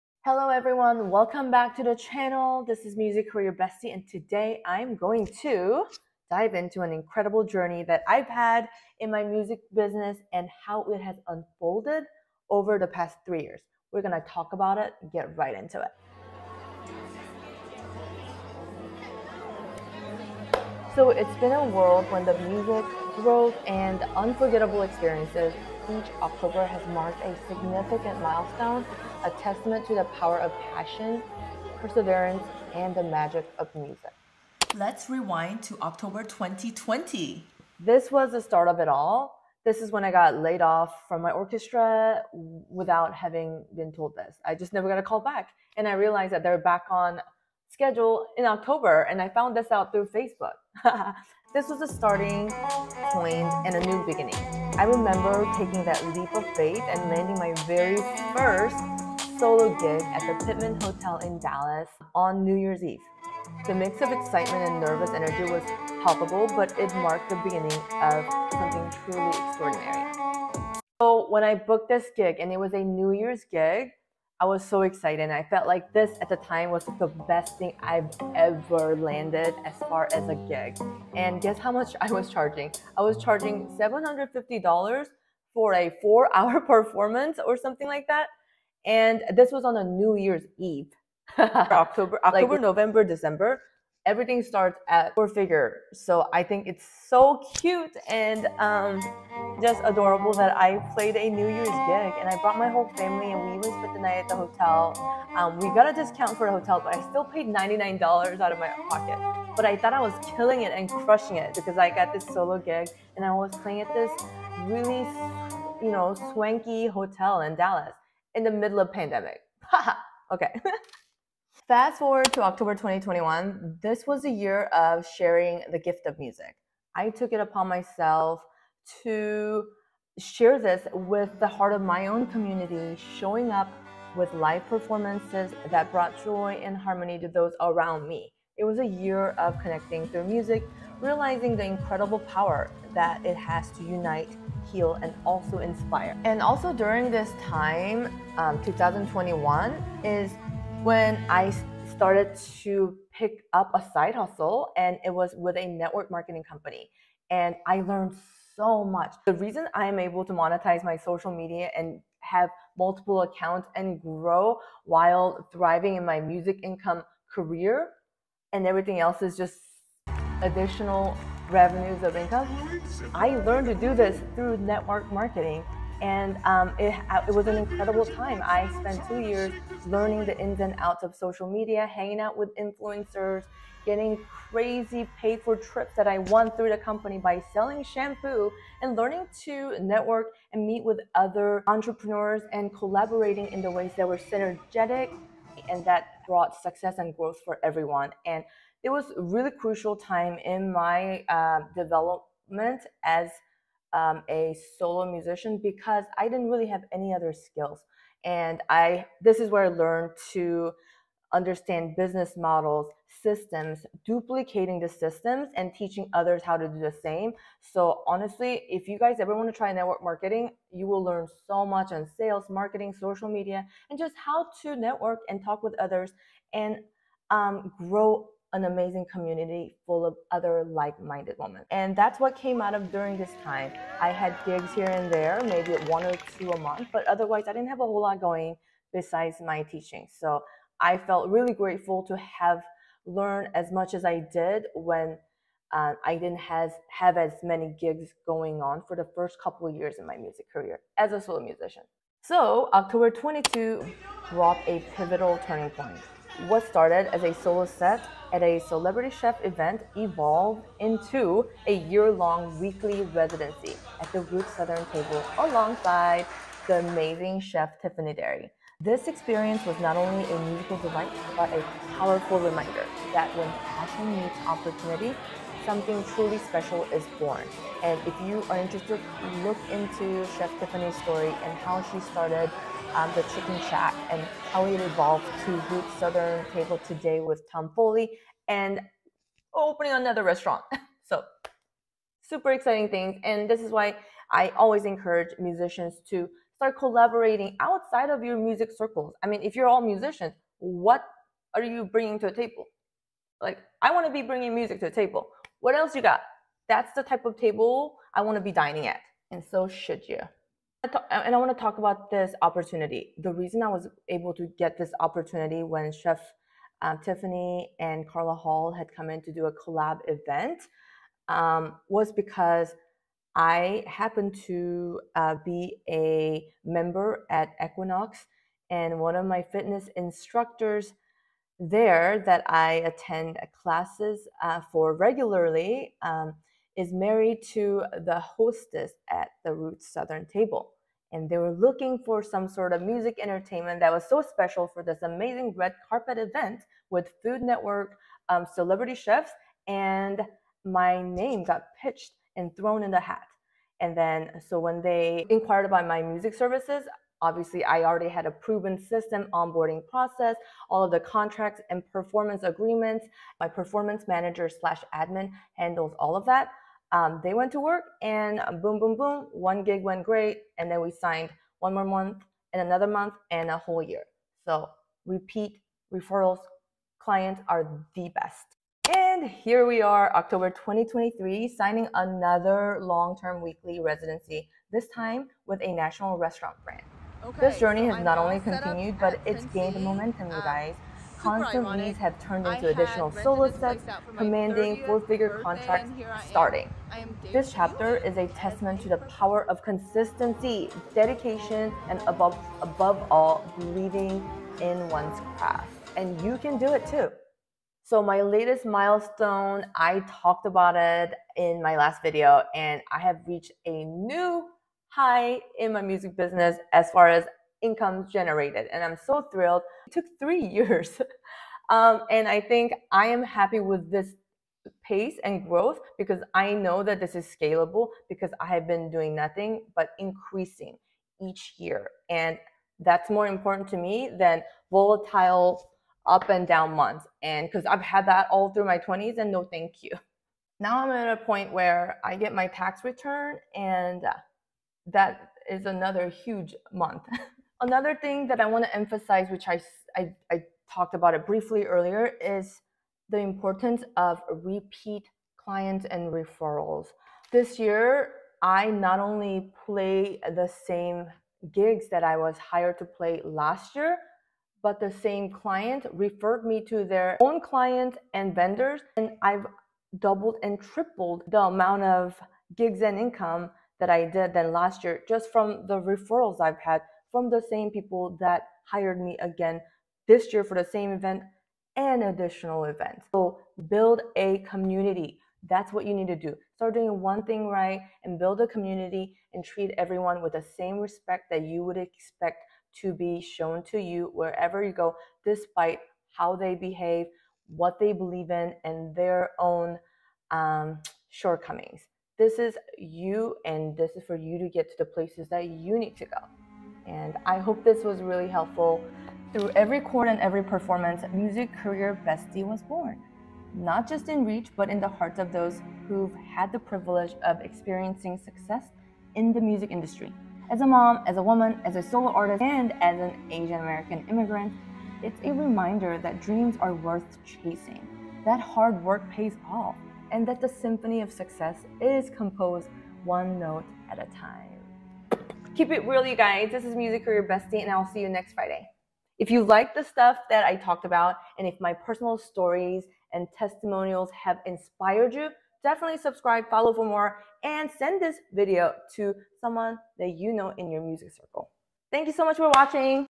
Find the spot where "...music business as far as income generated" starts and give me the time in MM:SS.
06:55.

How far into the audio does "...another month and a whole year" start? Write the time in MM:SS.
06:12.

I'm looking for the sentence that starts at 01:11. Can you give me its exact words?
So when I booked this gig, and it was a New Year's gig, I was so excited.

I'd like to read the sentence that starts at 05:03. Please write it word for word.
Like, I want to be bringing music to a table.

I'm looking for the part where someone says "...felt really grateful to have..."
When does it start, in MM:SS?
04:00.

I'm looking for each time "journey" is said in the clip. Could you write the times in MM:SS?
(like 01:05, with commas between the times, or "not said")
00:07, 06:27.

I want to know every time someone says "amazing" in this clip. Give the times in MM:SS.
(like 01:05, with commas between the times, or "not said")
03:48, 04:26, 05:45.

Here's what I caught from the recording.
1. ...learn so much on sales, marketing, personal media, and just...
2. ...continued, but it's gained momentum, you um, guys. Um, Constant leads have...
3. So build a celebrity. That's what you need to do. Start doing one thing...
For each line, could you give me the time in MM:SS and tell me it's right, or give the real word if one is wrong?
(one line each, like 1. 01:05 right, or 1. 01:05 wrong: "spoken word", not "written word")
1. 03:41 wrong: "social", not "personal"
2. 06:28 right
3. 08:03 wrong: "community", not "celebrity".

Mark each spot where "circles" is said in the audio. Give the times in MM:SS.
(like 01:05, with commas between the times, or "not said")
04:58, 09:11.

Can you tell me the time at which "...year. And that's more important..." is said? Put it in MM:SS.
07:11.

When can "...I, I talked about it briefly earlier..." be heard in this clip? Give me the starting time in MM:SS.
07:29.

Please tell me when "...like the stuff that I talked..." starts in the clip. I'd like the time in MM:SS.
08:59.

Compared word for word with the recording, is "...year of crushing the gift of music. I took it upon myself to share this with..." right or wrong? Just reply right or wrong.
wrong.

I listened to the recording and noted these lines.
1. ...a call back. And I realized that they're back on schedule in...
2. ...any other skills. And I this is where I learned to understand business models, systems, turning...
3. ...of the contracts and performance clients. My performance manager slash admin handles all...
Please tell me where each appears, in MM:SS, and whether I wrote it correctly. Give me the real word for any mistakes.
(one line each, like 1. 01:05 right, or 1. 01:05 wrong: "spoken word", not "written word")
1. 00:44 right
2. 03:26 wrong: "duplicating", not "turning"
3. 06:00 wrong: "agreements", not "clients".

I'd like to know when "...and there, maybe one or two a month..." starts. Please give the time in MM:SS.
03:54.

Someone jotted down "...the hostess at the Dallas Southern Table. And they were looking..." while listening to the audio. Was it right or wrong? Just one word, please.
wrong.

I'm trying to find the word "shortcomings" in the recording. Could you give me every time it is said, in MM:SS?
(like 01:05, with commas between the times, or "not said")
08:21.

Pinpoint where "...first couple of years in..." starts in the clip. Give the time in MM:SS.
04:09.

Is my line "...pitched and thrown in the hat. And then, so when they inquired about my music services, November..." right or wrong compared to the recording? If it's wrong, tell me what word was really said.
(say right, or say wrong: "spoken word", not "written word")
wrong: "Obviously", not "November".